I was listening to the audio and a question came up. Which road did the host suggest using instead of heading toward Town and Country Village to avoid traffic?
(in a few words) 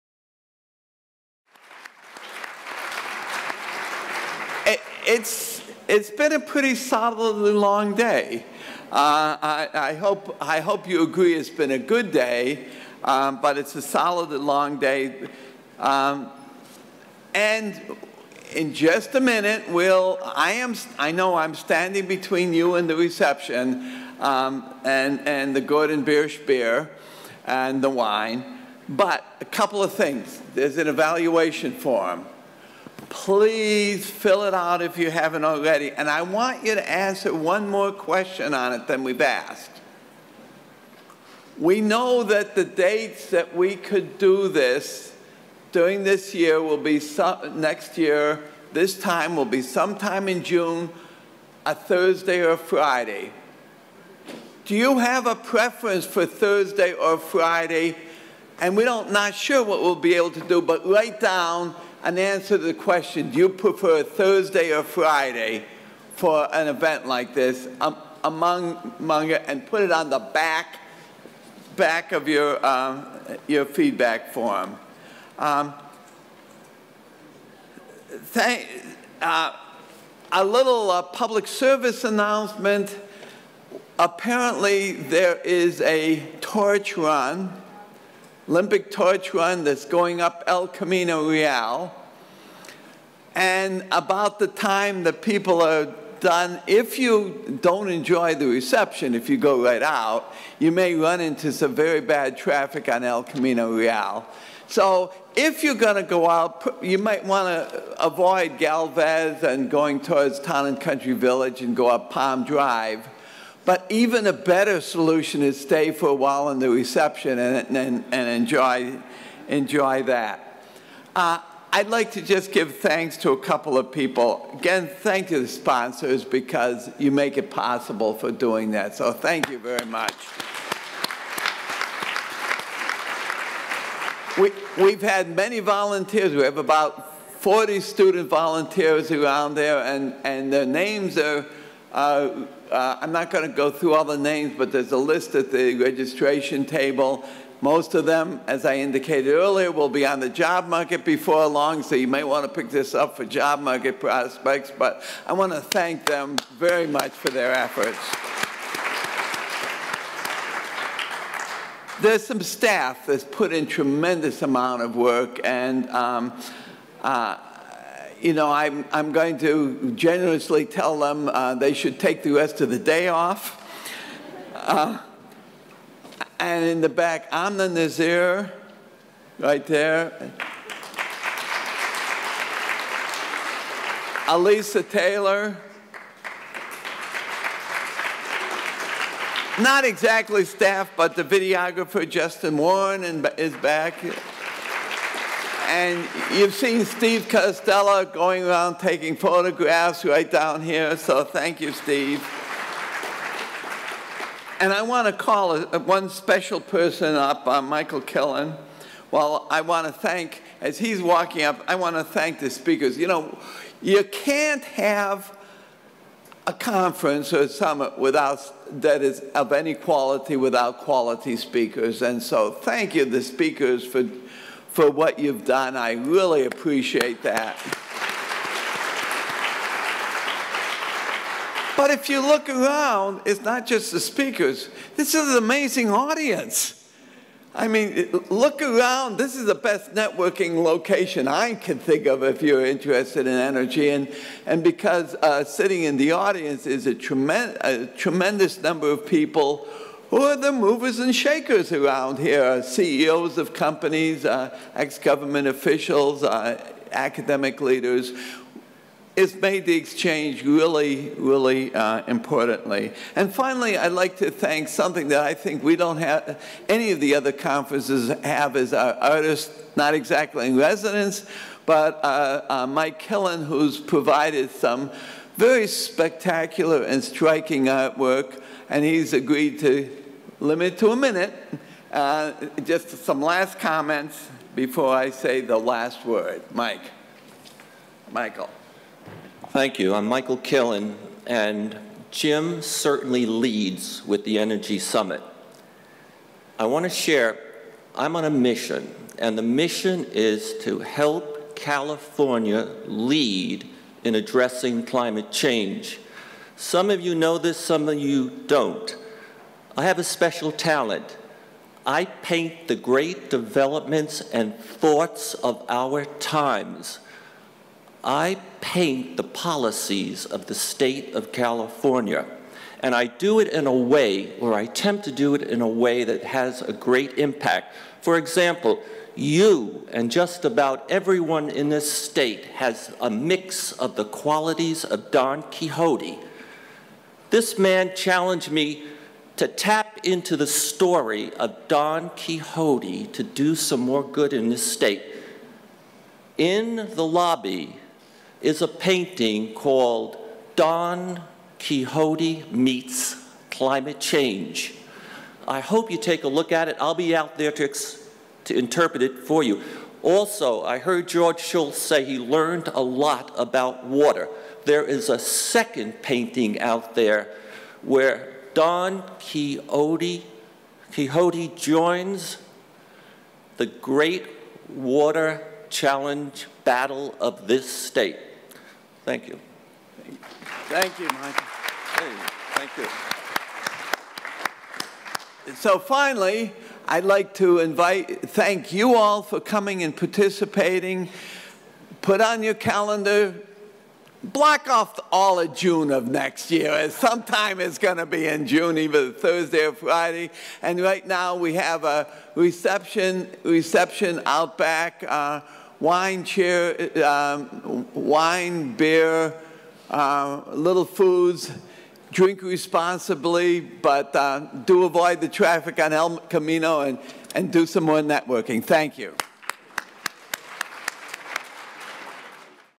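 Palm Drive.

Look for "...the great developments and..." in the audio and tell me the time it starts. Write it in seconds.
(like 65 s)
312 s.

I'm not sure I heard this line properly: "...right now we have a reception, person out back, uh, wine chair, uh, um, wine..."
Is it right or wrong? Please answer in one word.
wrong.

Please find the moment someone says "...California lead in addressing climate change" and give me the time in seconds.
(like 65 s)
301 s.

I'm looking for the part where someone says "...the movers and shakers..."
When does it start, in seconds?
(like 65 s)
250 s.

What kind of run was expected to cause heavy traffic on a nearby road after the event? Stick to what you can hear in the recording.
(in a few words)
Olympic torch run.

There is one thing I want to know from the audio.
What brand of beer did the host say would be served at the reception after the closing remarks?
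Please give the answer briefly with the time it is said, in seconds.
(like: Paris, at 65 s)
Gordon Biersch, at 25 s.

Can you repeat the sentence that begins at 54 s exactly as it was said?
Do you have a preference for Thursday or Friday?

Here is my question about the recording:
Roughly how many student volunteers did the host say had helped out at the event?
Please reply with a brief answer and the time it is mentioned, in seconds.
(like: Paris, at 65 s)
40, at 137 s.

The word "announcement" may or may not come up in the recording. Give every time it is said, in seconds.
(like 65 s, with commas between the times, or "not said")
82 s.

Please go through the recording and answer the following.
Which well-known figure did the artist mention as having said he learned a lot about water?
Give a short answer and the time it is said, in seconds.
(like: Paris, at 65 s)
George Shultz, at 361 s.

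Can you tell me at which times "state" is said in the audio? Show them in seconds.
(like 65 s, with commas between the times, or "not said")
320 s, 331 s, 344 s, 377 s.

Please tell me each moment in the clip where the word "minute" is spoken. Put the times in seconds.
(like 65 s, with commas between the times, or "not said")
19 s, 280 s.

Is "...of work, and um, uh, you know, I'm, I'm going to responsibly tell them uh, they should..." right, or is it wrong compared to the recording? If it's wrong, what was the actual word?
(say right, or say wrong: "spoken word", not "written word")
wrong: "generously", not "responsibly".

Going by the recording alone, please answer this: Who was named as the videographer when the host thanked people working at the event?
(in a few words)
Justin Warren.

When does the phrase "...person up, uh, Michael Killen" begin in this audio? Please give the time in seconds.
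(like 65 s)
206 s.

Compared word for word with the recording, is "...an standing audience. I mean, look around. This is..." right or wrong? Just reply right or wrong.
wrong.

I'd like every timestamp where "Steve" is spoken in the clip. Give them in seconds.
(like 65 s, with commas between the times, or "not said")
196 s, 201 s.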